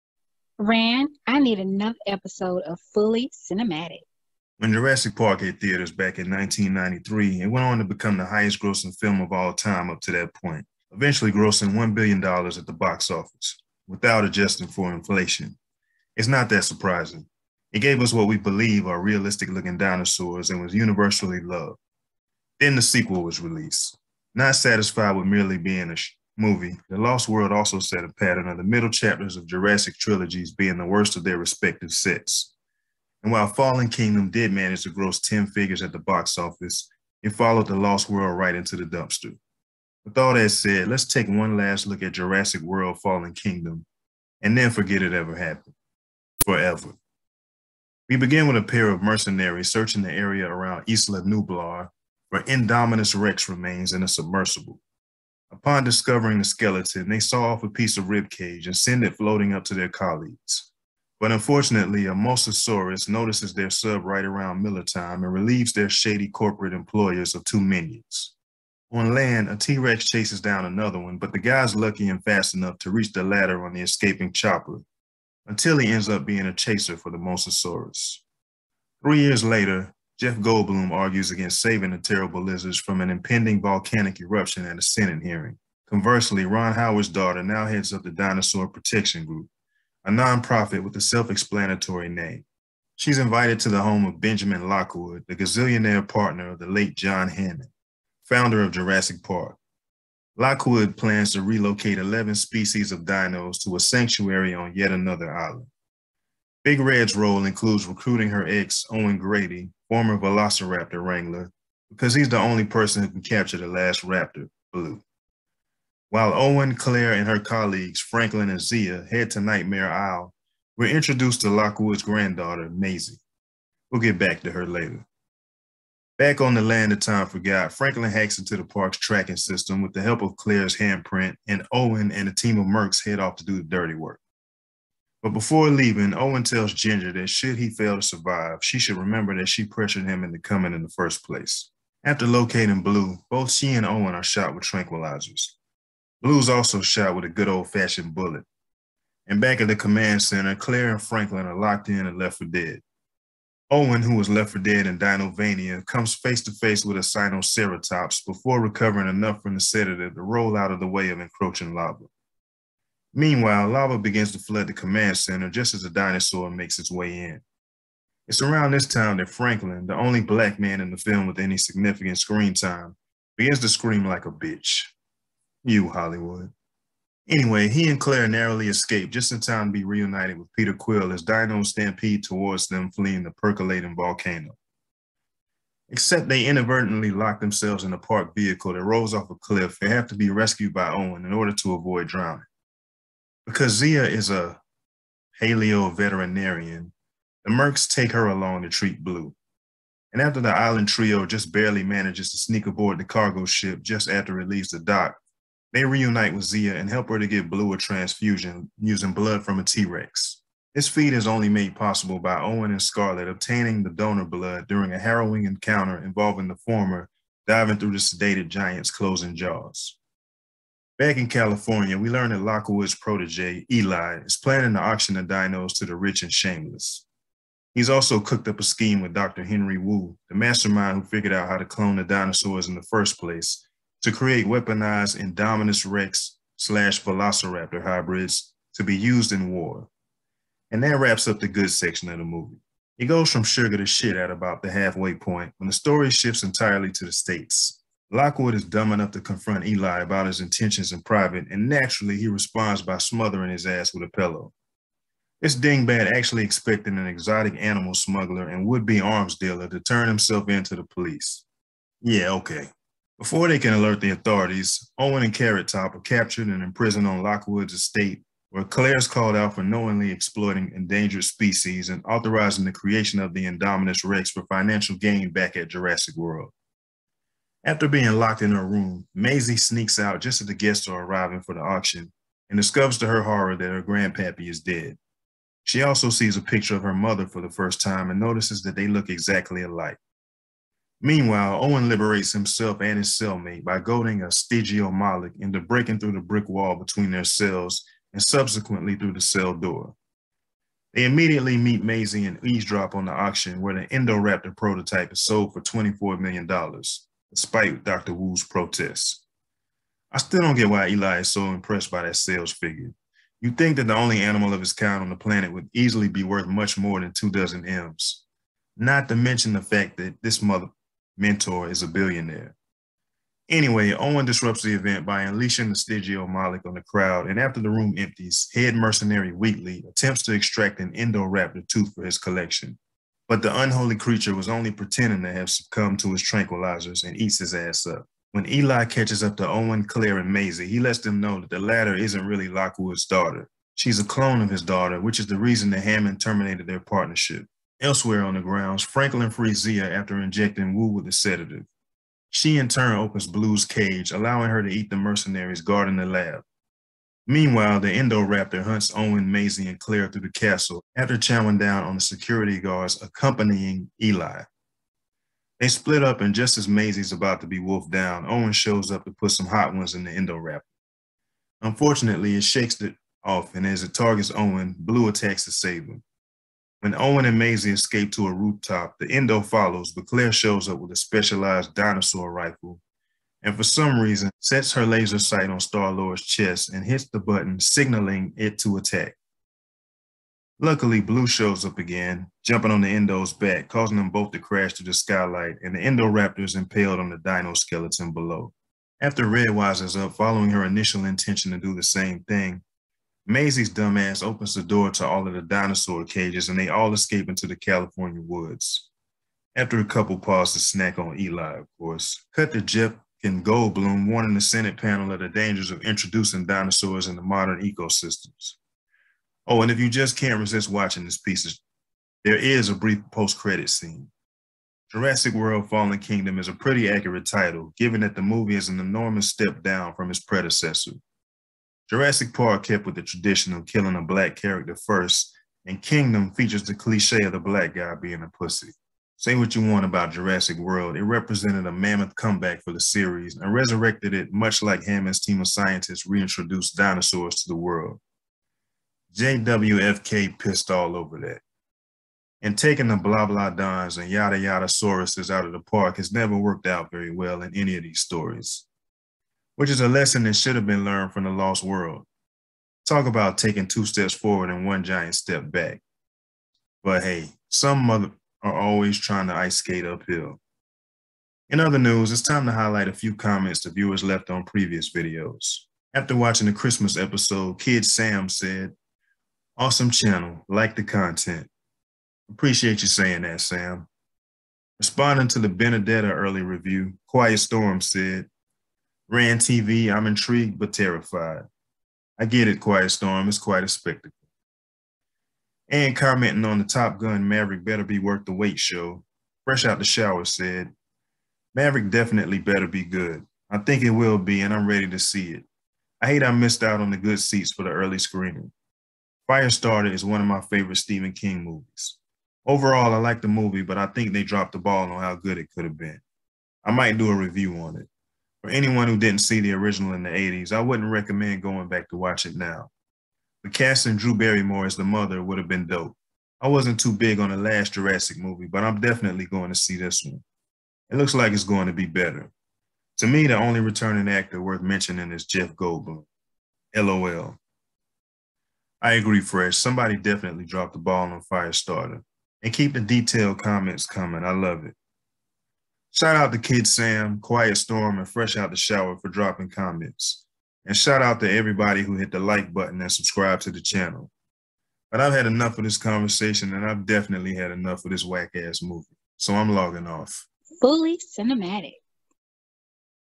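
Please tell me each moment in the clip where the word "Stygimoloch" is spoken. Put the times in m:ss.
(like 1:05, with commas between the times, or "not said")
4:54, 5:25.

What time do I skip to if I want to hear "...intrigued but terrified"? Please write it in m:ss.
8:10.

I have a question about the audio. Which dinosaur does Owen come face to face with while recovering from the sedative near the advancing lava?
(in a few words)
Sinoceratops.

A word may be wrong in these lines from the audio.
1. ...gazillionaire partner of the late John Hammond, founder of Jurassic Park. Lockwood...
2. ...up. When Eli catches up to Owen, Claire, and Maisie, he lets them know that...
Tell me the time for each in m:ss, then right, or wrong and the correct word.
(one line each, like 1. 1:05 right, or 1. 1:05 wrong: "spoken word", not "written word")
1. 1:35 right
2. 5:37 right.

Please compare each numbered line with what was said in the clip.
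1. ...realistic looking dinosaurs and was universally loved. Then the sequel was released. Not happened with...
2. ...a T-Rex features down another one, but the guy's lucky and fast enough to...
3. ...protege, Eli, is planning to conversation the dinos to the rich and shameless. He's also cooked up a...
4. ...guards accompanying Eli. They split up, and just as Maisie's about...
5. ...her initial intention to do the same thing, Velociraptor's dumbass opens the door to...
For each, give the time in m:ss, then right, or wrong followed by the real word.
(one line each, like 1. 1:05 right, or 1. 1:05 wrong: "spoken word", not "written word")
1. 0:19 wrong: "satisfied", not "happened"
2. 1:09 wrong: "chases", not "features"
3. 3:42 wrong: "auction", not "conversation"
4. 6:02 right
5. 6:40 wrong: "Maisie", not "Velociraptor".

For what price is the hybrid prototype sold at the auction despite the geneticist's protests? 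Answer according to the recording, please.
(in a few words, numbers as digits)
$24 million.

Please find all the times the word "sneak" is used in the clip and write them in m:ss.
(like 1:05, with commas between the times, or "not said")
3:22, 4:39.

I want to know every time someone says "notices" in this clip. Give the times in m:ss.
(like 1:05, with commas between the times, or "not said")
1:03, 4:48.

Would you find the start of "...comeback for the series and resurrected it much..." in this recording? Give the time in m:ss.
7:22.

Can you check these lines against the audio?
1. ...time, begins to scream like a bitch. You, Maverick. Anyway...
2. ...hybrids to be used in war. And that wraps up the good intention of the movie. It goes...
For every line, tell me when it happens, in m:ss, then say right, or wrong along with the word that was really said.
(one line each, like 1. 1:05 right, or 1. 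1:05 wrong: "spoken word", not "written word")
1. 2:52 wrong: "Hollywood", not "Maverick"
2. 3:57 wrong: "section", not "intention".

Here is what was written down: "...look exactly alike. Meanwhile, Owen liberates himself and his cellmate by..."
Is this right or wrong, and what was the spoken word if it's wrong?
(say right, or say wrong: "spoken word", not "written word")
right.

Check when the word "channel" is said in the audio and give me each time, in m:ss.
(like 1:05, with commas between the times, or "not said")
7:59, 9:13.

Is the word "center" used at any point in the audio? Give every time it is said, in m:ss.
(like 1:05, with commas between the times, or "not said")
2:30, 2:45.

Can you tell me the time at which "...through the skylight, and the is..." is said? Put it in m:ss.
6:34.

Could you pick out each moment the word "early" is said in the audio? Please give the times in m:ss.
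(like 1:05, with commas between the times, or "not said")
8:06, 8:27.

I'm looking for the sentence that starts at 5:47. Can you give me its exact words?
Elsewhere on the grounds, Franklin frees Zia after injecting Wu with a sedative.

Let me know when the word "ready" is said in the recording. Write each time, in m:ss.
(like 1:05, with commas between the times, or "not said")
8:24.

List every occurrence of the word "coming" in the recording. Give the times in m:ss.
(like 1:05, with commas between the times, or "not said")
2:20, 9:03.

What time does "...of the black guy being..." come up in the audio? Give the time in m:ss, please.
7:17.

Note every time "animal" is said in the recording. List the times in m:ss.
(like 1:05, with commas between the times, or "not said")
4:17, 5:14.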